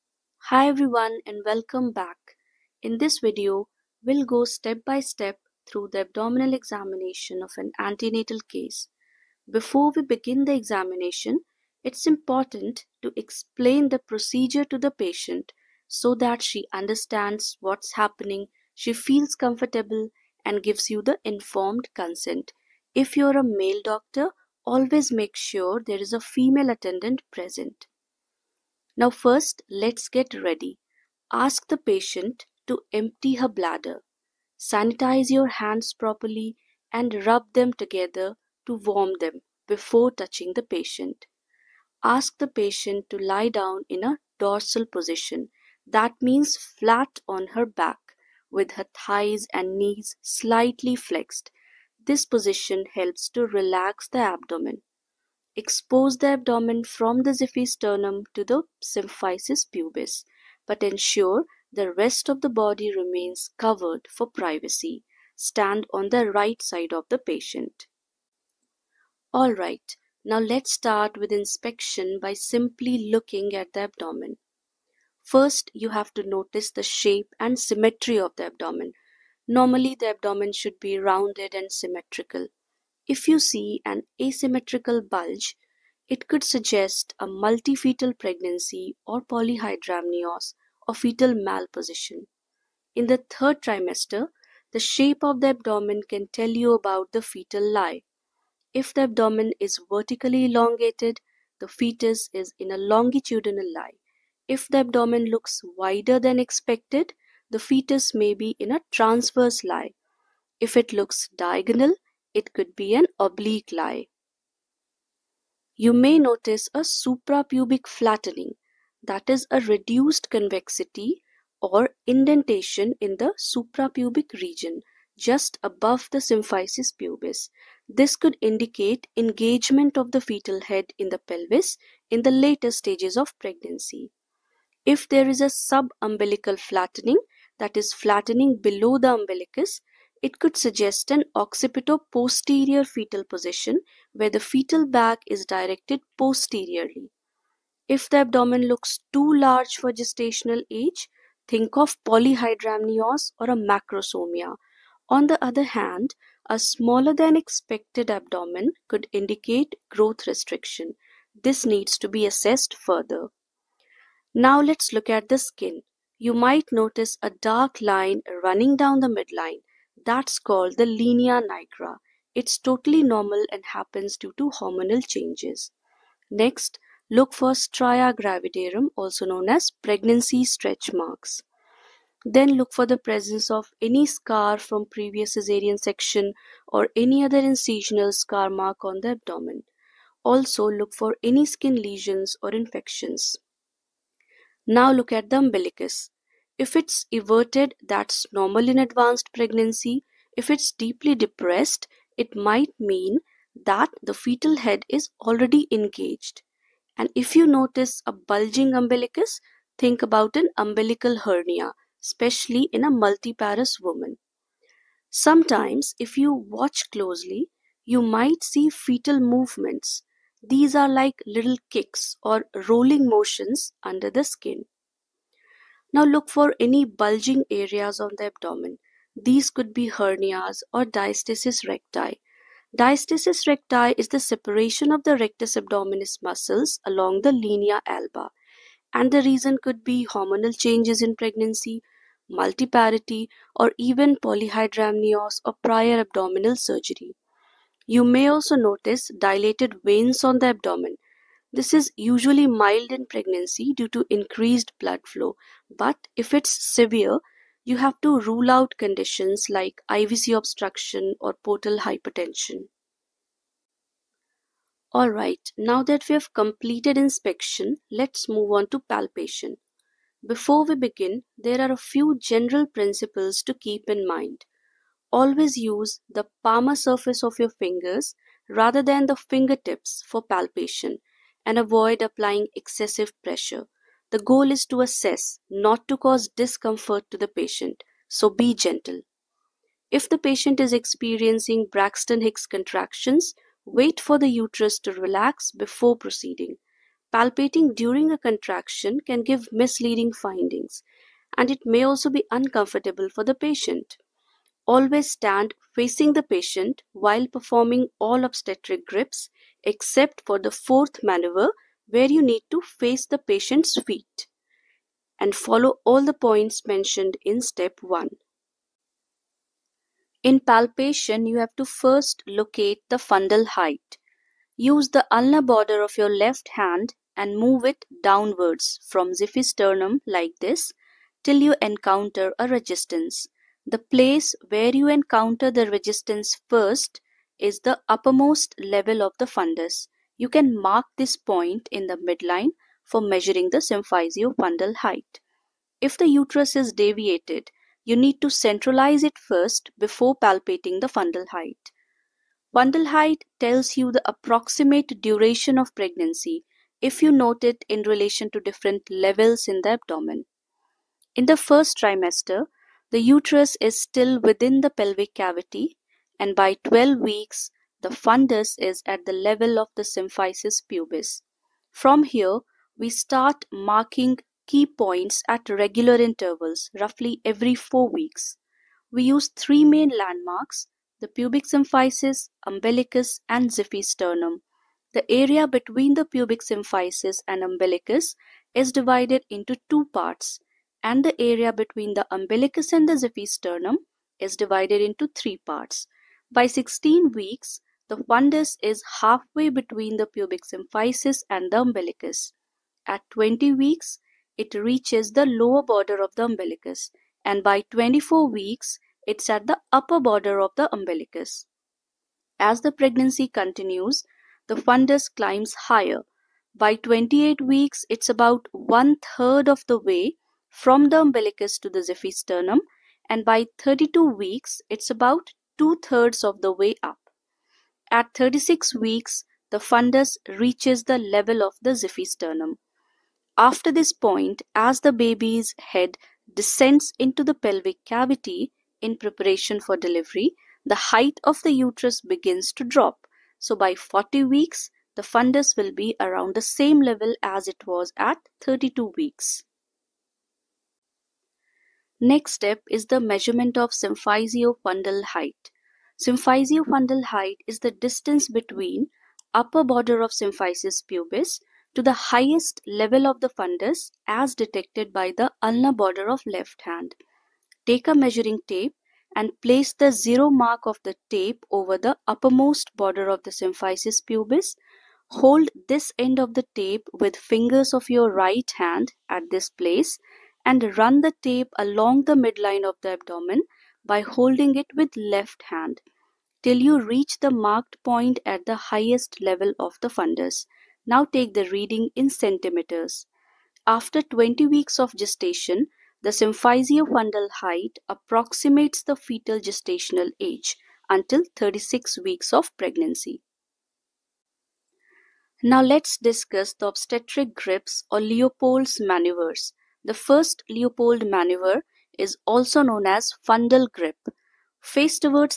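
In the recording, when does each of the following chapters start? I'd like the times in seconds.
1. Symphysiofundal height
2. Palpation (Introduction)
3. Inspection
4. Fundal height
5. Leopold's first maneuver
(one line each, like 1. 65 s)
1. 451 s
2. 263 s
3. 68 s
4. 318 s
5. 504 s.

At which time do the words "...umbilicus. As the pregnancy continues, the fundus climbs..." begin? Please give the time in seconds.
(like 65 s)
410 s.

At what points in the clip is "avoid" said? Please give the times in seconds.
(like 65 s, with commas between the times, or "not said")
281 s.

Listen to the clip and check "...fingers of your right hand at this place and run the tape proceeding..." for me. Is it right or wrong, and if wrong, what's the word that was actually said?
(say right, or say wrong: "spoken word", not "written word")
wrong: "along", not "proceeding".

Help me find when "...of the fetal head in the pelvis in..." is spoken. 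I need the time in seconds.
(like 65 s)
129 s.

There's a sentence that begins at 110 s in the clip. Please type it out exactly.
If it looks diagonal, it could be an oblique lie.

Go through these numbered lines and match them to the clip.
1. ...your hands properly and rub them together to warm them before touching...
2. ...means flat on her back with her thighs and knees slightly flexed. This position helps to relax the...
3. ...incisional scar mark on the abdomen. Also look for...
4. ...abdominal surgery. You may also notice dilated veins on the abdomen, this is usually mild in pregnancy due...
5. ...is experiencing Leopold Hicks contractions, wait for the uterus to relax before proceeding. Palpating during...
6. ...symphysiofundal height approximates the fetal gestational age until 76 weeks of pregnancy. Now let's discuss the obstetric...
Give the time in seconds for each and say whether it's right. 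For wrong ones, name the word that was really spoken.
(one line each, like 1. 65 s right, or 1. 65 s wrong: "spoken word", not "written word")
1. 35 s right
2. 46 s right
3. 187 s right
4. 246 s right
5. 290 s wrong: "Braxton", not "Leopold"
6. 496 s wrong: "36", not "76".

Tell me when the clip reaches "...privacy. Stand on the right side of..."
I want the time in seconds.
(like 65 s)
64 s.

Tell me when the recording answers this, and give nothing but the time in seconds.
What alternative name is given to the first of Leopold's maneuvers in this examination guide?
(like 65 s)
513 s.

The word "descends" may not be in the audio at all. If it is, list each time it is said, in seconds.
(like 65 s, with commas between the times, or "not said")
436 s.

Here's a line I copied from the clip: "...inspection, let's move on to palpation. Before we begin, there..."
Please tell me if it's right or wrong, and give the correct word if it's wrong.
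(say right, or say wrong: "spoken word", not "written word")
right.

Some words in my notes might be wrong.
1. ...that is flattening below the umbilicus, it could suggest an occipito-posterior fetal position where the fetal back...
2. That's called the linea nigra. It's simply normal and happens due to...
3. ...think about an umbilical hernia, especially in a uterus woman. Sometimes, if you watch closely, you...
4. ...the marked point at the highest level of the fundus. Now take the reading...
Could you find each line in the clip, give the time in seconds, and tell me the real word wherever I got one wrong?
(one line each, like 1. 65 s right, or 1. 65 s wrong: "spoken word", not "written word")
1. 137 s right
2. 170 s wrong: "totally", not "simply"
3. 209 s wrong: "multiparous", not "uterus"
4. 487 s right.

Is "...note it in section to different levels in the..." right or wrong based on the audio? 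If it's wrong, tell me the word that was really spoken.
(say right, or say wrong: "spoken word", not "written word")
wrong: "relation", not "section".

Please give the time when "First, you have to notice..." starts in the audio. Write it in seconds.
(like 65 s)
75 s.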